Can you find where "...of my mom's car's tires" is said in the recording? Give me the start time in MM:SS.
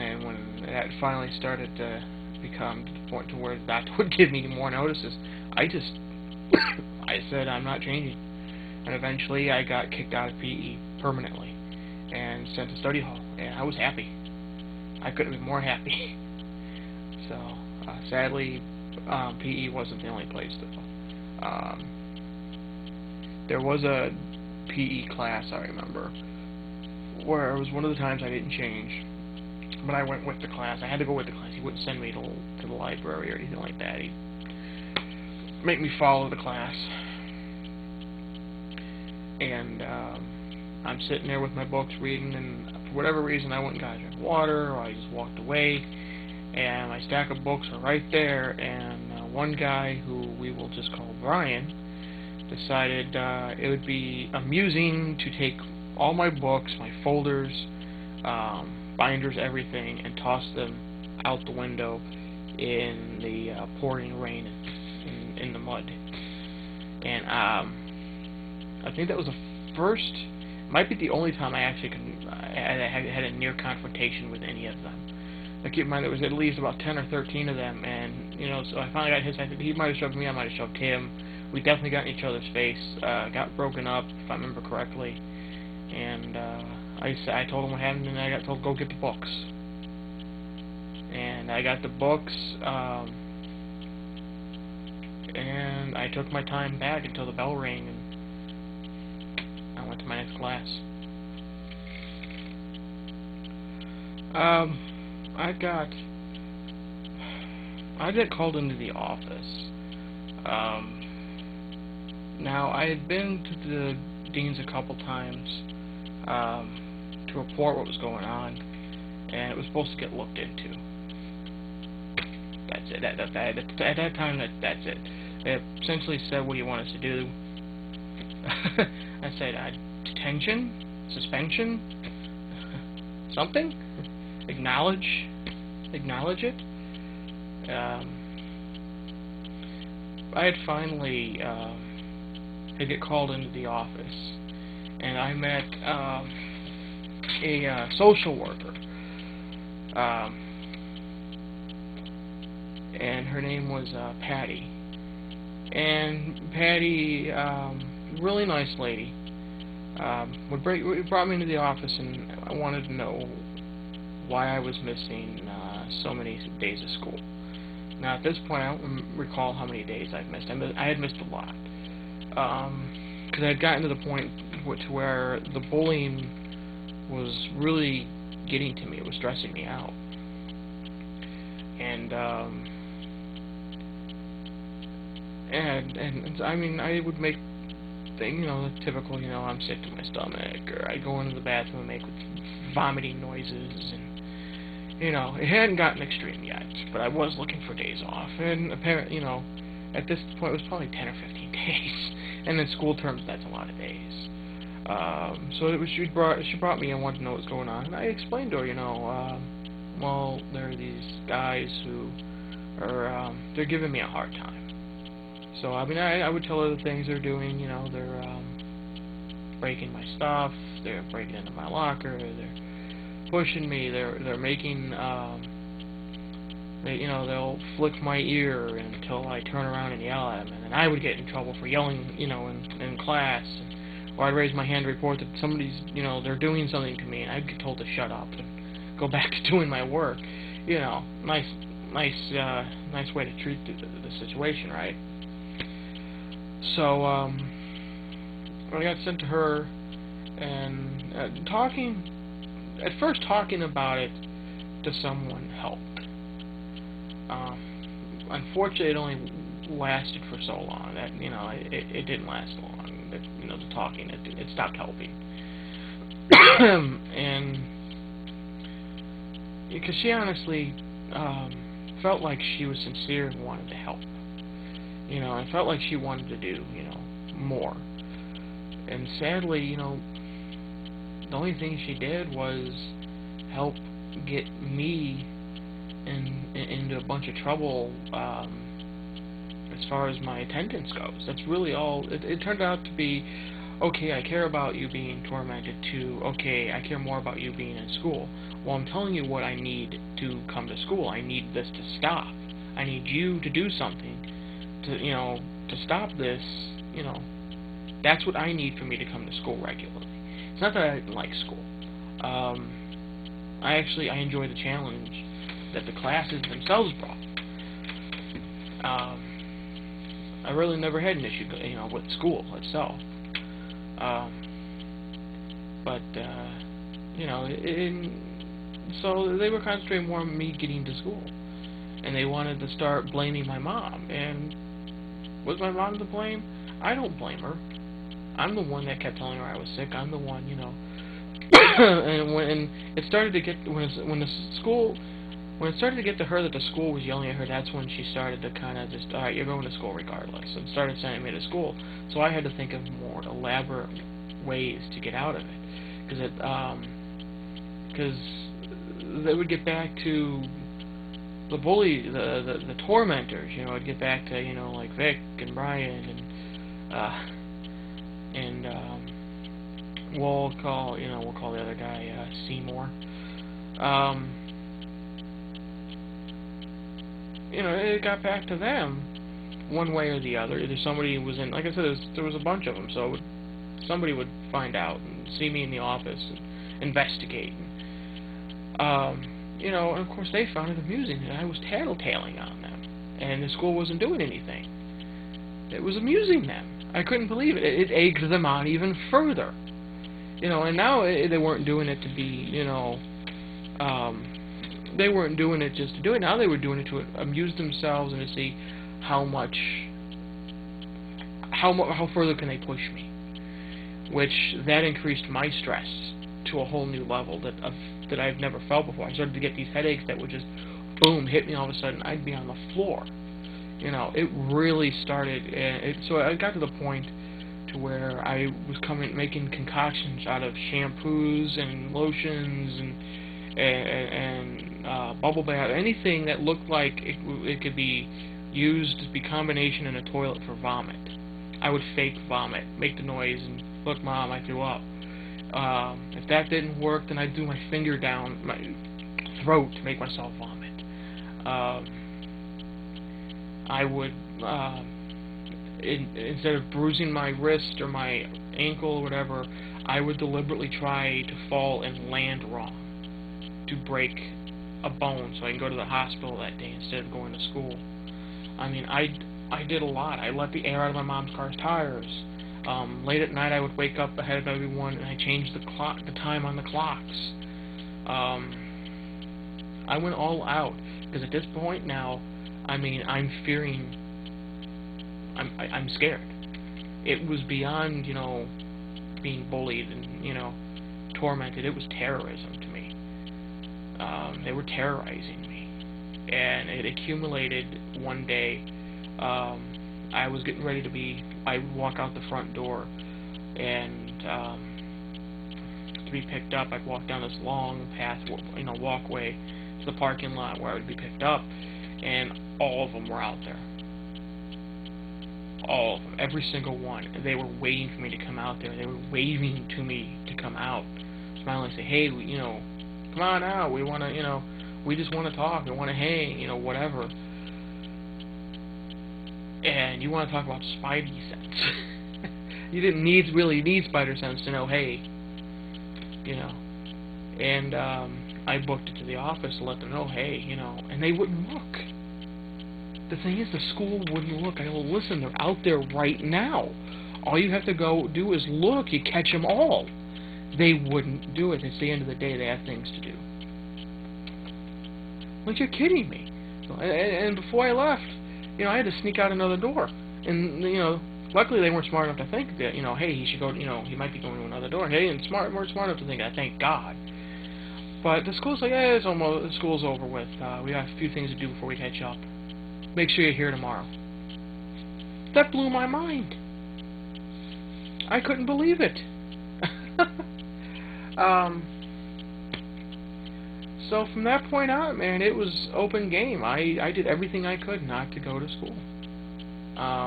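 07:50.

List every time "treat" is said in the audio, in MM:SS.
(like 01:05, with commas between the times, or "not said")
04:03.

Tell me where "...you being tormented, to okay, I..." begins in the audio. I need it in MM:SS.
04:54.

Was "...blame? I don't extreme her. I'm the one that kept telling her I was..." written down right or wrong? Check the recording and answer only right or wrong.
wrong.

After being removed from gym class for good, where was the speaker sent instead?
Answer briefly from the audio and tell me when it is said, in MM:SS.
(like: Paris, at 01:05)
study hall, at 00:12.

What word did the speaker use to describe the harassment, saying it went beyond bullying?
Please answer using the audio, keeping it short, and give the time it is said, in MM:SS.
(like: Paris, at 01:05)
terrorism, at 08:11.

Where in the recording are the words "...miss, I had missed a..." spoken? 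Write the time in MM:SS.
02:50.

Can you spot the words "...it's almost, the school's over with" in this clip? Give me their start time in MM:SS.
09:28.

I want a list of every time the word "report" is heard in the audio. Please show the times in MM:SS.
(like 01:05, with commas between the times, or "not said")
01:57, 03:54.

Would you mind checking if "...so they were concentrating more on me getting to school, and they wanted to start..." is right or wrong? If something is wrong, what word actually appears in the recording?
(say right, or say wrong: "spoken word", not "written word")
right.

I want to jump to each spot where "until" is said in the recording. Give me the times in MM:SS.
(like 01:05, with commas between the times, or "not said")
01:37, 03:48.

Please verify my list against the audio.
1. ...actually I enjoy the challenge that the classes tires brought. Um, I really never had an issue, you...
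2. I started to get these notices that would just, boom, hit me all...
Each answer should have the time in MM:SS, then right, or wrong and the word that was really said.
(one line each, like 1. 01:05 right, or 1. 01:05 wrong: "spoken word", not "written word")
1. 05:13 wrong: "themselves", not "tires"
2. 06:59 wrong: "headaches", not "notices".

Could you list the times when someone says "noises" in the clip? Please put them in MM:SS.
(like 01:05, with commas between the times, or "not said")
03:13, 07:23.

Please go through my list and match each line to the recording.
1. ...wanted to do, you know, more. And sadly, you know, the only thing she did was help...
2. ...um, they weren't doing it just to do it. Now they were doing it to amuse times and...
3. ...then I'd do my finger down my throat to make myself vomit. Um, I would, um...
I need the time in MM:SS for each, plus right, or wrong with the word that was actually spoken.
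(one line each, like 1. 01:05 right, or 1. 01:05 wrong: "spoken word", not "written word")
1. 04:35 right
2. 06:43 wrong: "themselves", not "times"
3. 07:27 right.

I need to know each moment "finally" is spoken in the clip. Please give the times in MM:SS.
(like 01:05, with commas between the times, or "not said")
00:00, 01:18, 02:20.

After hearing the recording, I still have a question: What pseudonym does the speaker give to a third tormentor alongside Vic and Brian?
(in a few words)
Seymour.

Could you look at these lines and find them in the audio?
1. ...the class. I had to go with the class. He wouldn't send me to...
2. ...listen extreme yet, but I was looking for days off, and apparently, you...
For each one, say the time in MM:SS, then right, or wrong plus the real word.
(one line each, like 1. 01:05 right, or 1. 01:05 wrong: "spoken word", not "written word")
1. 00:30 right
2. 03:15 wrong: "gotten", not "listen".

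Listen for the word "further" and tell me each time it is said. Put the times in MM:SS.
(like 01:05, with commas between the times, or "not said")
06:39, 06:52.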